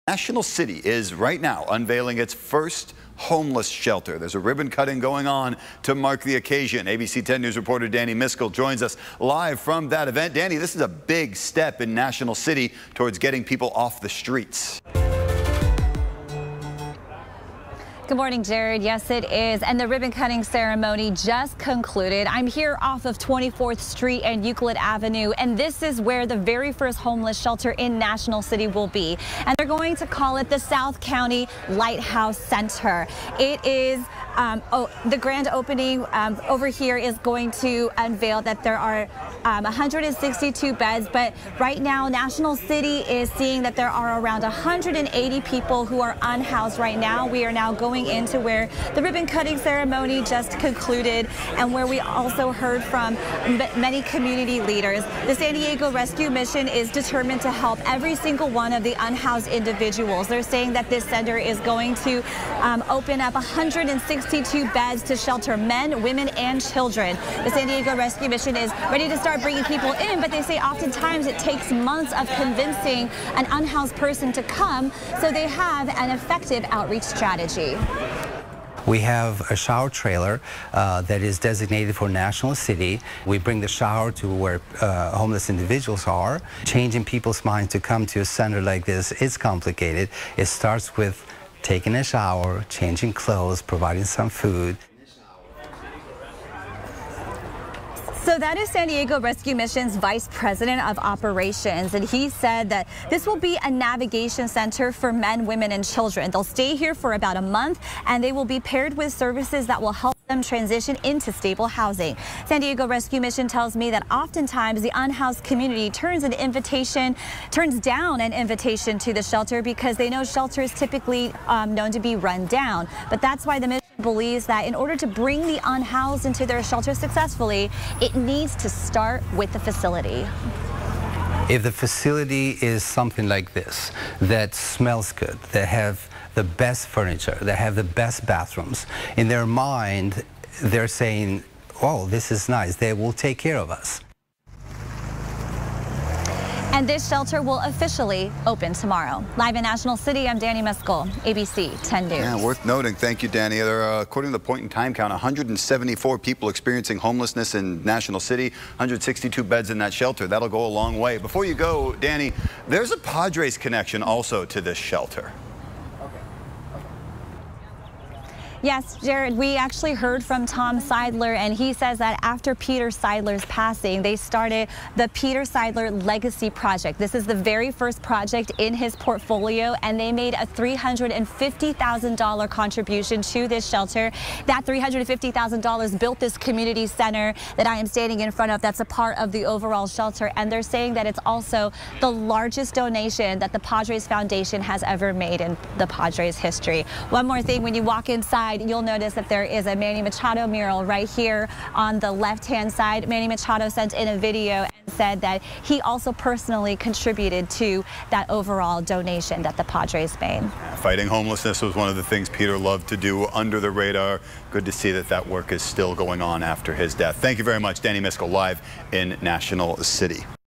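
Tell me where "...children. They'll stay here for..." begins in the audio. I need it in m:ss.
1:45.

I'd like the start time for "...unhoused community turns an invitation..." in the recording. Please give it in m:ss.
1:54.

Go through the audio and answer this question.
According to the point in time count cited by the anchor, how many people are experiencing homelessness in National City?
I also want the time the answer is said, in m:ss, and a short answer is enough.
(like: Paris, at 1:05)
174, at 2:35.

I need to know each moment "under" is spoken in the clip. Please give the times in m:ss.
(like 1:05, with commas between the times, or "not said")
3:33.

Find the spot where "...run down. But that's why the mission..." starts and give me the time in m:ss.
2:02.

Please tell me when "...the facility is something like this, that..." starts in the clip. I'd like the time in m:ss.
2:11.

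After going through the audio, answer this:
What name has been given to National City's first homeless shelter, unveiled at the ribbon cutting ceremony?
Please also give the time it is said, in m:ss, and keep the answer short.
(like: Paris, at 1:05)
South County Lighthouse Center, at 0:30.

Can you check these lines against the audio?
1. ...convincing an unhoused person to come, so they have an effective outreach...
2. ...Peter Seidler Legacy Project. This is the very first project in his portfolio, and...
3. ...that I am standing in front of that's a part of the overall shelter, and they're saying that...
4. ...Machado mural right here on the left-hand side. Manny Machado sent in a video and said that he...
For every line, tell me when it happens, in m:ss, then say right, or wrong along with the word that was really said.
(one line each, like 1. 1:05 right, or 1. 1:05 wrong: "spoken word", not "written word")
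1. 1:12 right
2. 2:55 right
3. 3:07 right
4. 3:20 right.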